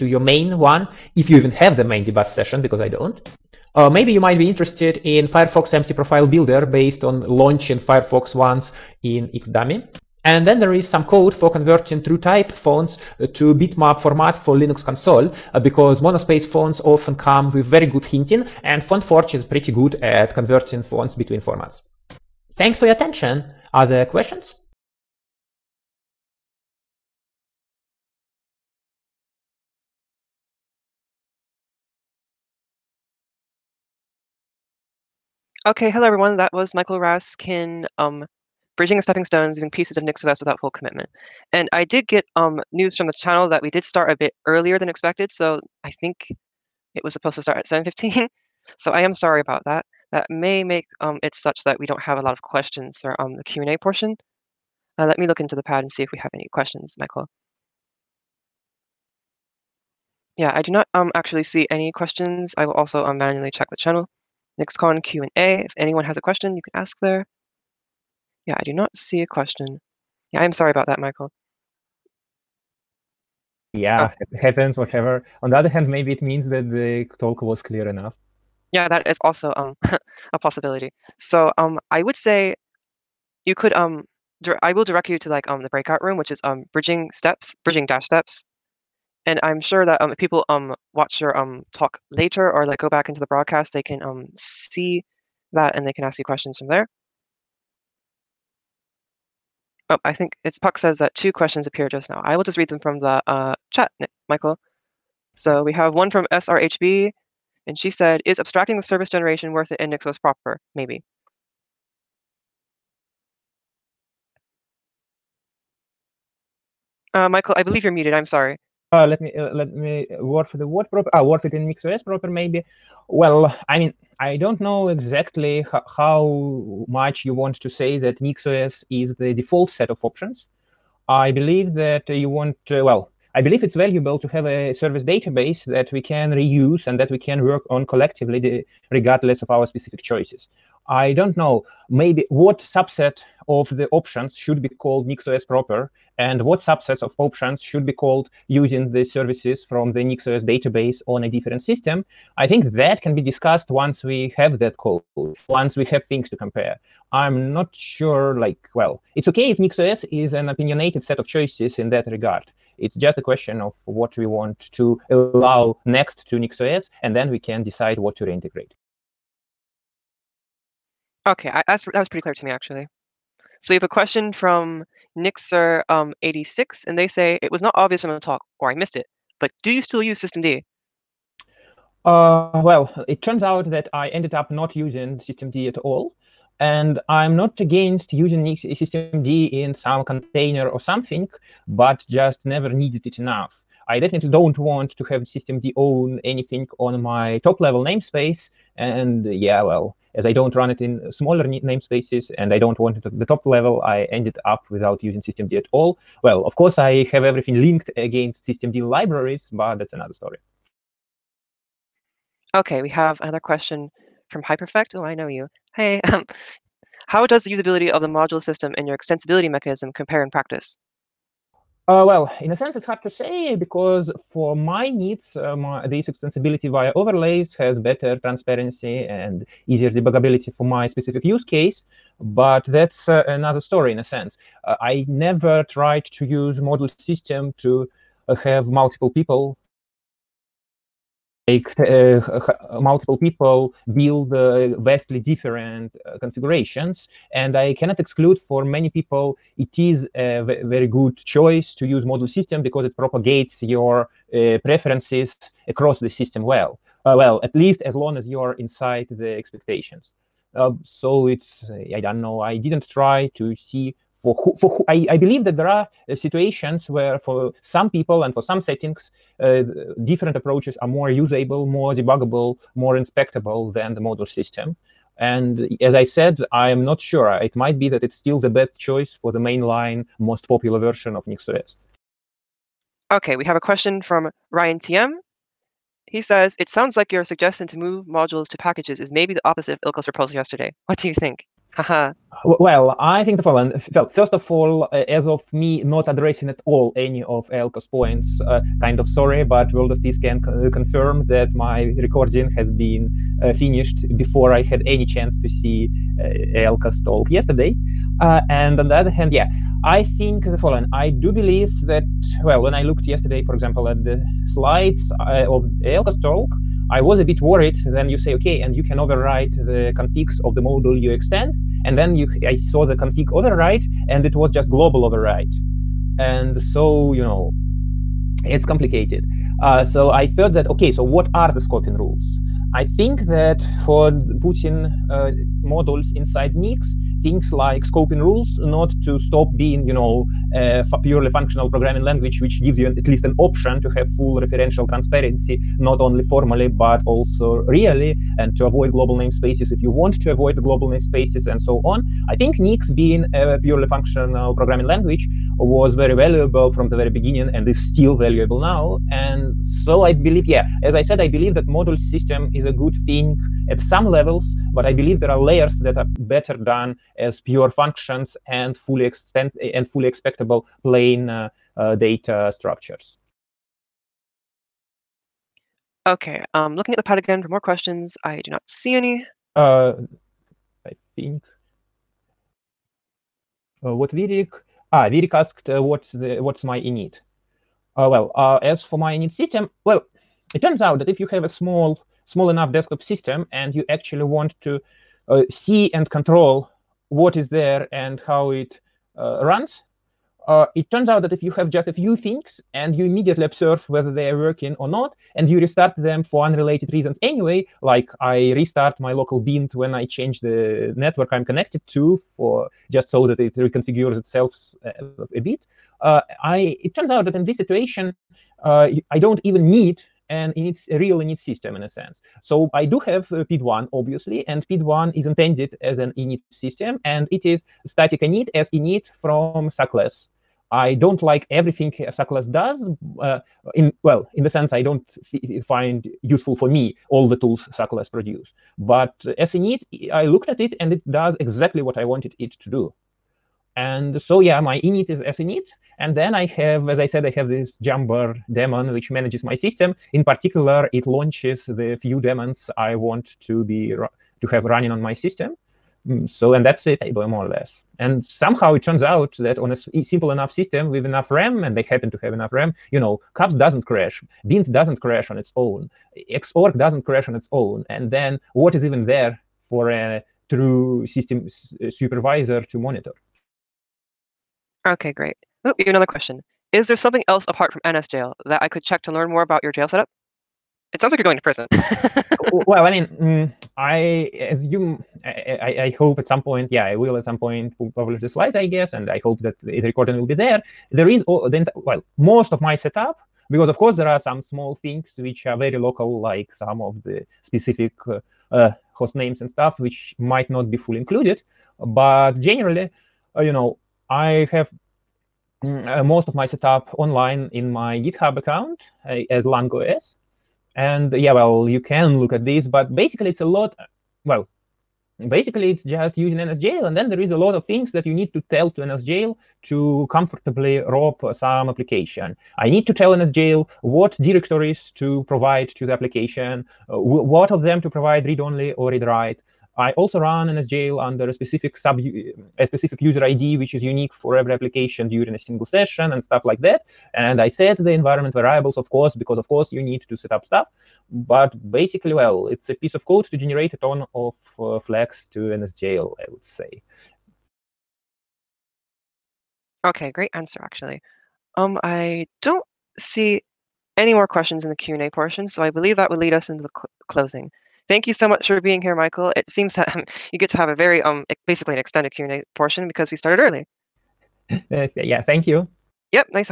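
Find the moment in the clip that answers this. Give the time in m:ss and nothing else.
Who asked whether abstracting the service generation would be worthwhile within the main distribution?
1:46.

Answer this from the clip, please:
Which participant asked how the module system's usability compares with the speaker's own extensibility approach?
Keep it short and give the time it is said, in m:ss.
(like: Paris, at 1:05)
hyperfekt, at 3:34.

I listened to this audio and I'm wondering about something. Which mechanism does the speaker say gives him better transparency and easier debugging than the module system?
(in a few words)
Overlays.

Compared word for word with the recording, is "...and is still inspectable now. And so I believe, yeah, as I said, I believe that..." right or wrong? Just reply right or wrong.
wrong.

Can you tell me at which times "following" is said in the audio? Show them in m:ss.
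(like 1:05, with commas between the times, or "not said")
4:53, 5:10.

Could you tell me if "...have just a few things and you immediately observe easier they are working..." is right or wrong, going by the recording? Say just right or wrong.
wrong.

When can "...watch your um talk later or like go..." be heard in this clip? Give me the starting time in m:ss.
1:30.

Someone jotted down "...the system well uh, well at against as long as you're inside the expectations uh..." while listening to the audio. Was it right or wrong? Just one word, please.
wrong.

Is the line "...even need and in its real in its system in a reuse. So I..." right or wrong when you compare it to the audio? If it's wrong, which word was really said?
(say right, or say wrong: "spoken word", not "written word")
wrong: "sense", not "reuse".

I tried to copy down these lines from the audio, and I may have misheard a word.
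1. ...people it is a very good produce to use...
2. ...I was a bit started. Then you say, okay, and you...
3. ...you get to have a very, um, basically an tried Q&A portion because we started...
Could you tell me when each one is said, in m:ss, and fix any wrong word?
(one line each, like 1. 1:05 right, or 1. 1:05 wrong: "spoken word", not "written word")
1. 4:08 wrong: "choice", not "produce"
2. 5:16 wrong: "worried", not "started"
3. 9:20 wrong: "extended", not "tried".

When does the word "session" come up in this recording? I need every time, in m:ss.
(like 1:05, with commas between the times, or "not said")
0:02, 8:55.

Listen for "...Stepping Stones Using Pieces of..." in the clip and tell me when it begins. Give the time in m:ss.
0:39.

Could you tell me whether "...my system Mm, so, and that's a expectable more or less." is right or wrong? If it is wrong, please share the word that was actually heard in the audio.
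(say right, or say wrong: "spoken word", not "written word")
wrong: "table", not "expectable".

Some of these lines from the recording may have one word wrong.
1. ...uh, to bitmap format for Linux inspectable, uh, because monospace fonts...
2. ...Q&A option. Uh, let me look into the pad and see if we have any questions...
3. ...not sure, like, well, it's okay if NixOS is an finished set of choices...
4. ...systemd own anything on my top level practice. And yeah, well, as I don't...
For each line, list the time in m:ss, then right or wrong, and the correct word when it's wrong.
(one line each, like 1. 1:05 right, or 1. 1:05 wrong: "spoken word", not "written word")
1. 0:13 wrong: "console", not "inspectable"
2. 0:53 wrong: "portion", not "option"
3. 2:37 wrong: "opinionated", not "finished"
4. 3:15 wrong: "namespace", not "practice".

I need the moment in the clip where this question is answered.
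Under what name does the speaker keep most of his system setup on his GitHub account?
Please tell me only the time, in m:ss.
8:29.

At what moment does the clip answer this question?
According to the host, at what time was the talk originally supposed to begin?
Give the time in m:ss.
0:47.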